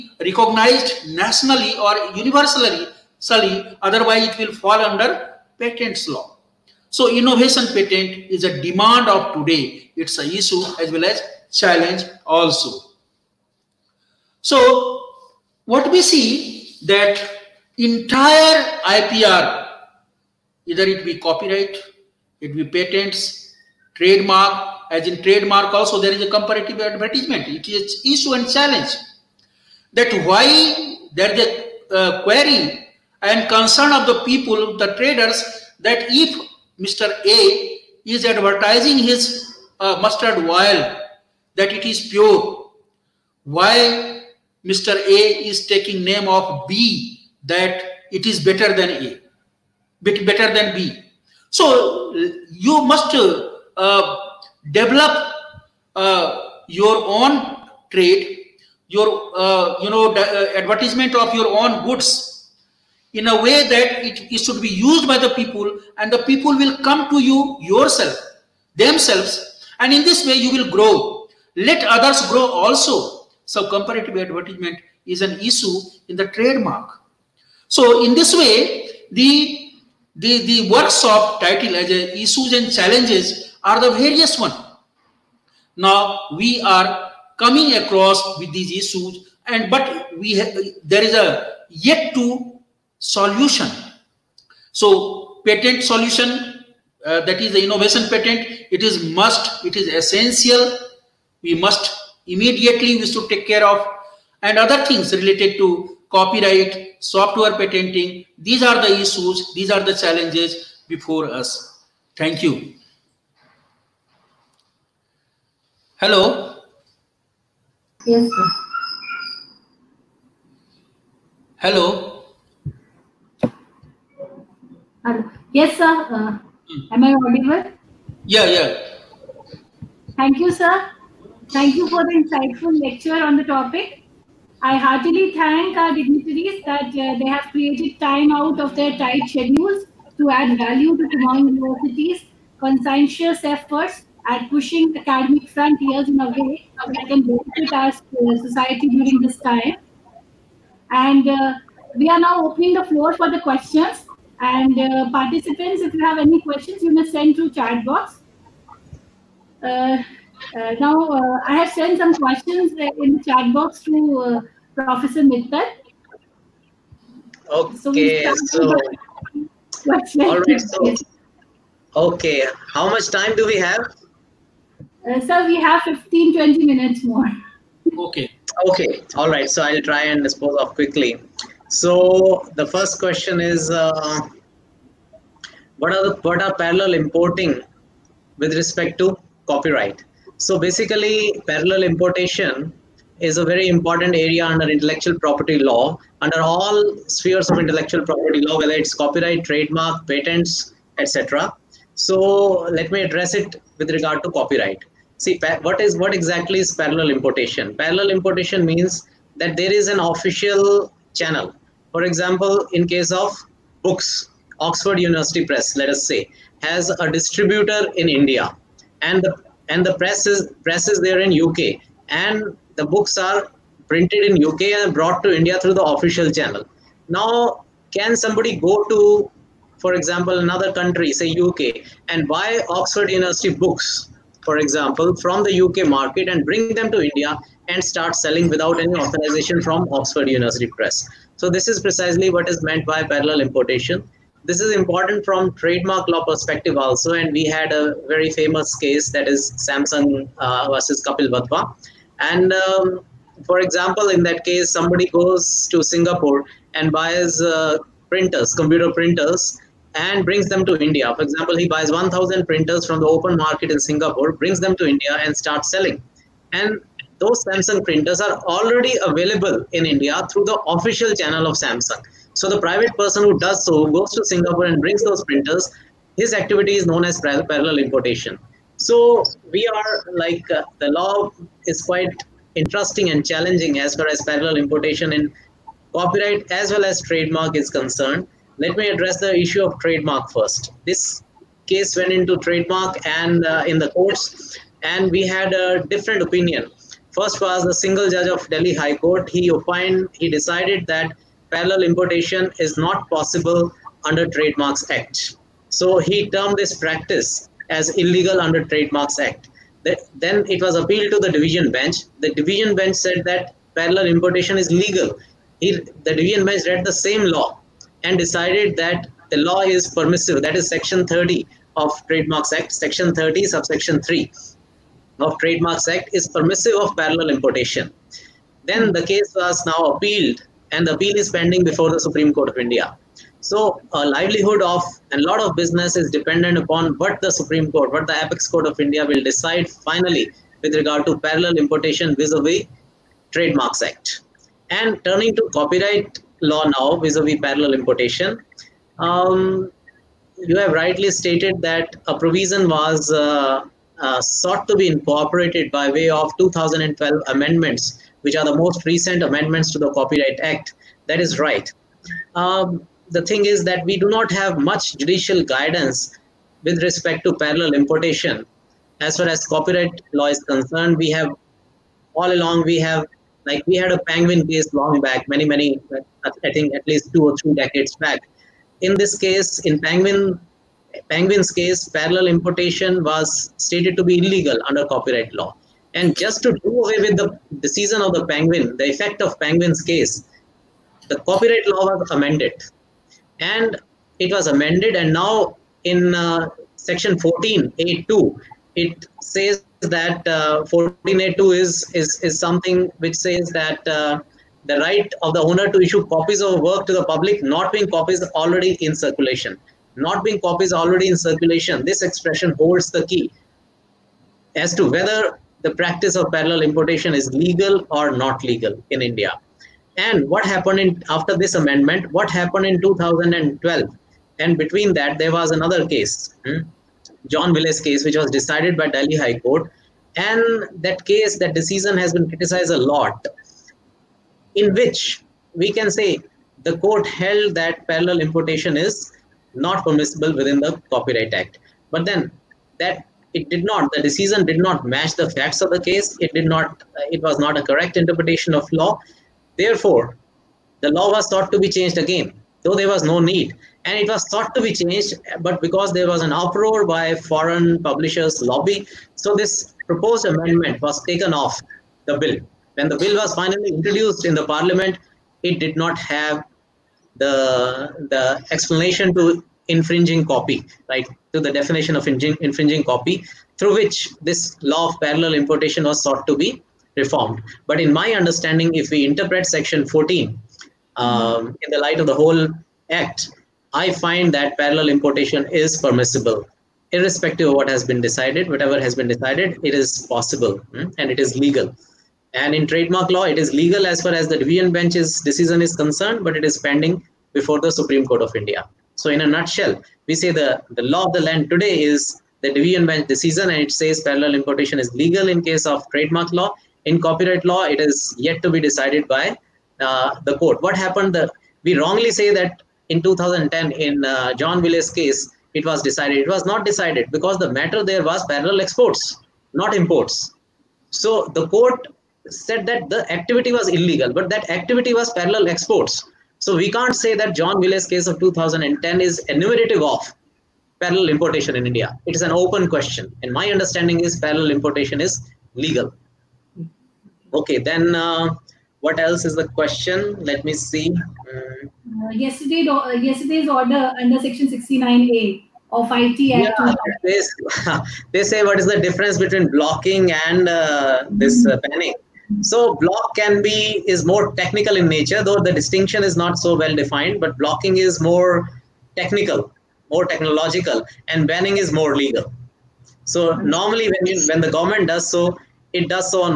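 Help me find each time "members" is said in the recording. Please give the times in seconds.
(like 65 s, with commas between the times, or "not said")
not said.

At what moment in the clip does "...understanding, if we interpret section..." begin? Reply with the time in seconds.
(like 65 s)
478 s.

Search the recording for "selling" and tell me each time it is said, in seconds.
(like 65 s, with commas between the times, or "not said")
238 s, 265 s.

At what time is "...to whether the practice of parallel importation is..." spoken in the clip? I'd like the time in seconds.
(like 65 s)
414 s.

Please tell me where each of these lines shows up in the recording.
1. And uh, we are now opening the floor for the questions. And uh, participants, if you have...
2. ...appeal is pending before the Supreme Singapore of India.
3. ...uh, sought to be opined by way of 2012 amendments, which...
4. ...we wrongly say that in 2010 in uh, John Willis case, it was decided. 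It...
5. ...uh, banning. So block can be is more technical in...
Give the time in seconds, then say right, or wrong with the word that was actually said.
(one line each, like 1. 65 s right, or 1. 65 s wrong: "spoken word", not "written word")
1. 150 s right
2. 330 s wrong: "Court", not "Singapore"
3. 354 s wrong: "incorporated", not "opined"
4. 511 s right
5. 551 s right.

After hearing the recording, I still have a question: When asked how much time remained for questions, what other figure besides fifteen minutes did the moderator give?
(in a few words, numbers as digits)
20.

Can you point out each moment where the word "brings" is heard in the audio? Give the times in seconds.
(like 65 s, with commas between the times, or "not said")
236 s, 260 s, 264 s, 274 s.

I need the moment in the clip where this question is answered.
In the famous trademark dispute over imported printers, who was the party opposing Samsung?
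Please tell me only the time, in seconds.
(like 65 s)
251 s.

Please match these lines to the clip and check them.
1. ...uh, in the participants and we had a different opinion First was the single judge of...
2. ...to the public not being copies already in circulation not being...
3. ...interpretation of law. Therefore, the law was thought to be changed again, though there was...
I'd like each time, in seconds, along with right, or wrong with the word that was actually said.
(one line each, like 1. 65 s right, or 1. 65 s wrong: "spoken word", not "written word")
1. 293 s wrong: "courts", not "participants"
2. 406 s right
3. 447 s right.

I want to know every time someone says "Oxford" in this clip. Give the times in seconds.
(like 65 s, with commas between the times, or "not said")
214 s, 232 s, 239 s.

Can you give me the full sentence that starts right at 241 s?
So this is precisely what is meant by parallel importation.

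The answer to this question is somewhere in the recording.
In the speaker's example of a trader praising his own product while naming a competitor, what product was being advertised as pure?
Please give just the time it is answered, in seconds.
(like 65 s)
40 s.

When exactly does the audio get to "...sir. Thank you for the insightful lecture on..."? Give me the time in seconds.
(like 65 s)
130 s.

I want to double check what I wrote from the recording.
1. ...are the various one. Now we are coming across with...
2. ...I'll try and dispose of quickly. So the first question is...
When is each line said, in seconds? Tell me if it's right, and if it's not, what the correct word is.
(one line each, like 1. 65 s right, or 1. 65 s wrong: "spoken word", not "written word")
1. 83 s right
2. 179 s right.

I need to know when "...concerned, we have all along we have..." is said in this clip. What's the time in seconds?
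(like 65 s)
370 s.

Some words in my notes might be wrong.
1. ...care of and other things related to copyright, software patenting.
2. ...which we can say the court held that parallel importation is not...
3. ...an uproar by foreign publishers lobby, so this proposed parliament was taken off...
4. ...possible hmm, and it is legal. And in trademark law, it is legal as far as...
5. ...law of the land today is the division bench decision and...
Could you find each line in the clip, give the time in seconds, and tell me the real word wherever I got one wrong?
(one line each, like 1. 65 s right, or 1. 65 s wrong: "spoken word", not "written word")
1. 103 s right
2. 434 s right
3. 456 s wrong: "amendment", not "parliament"
4. 490 s right
5. 500 s right.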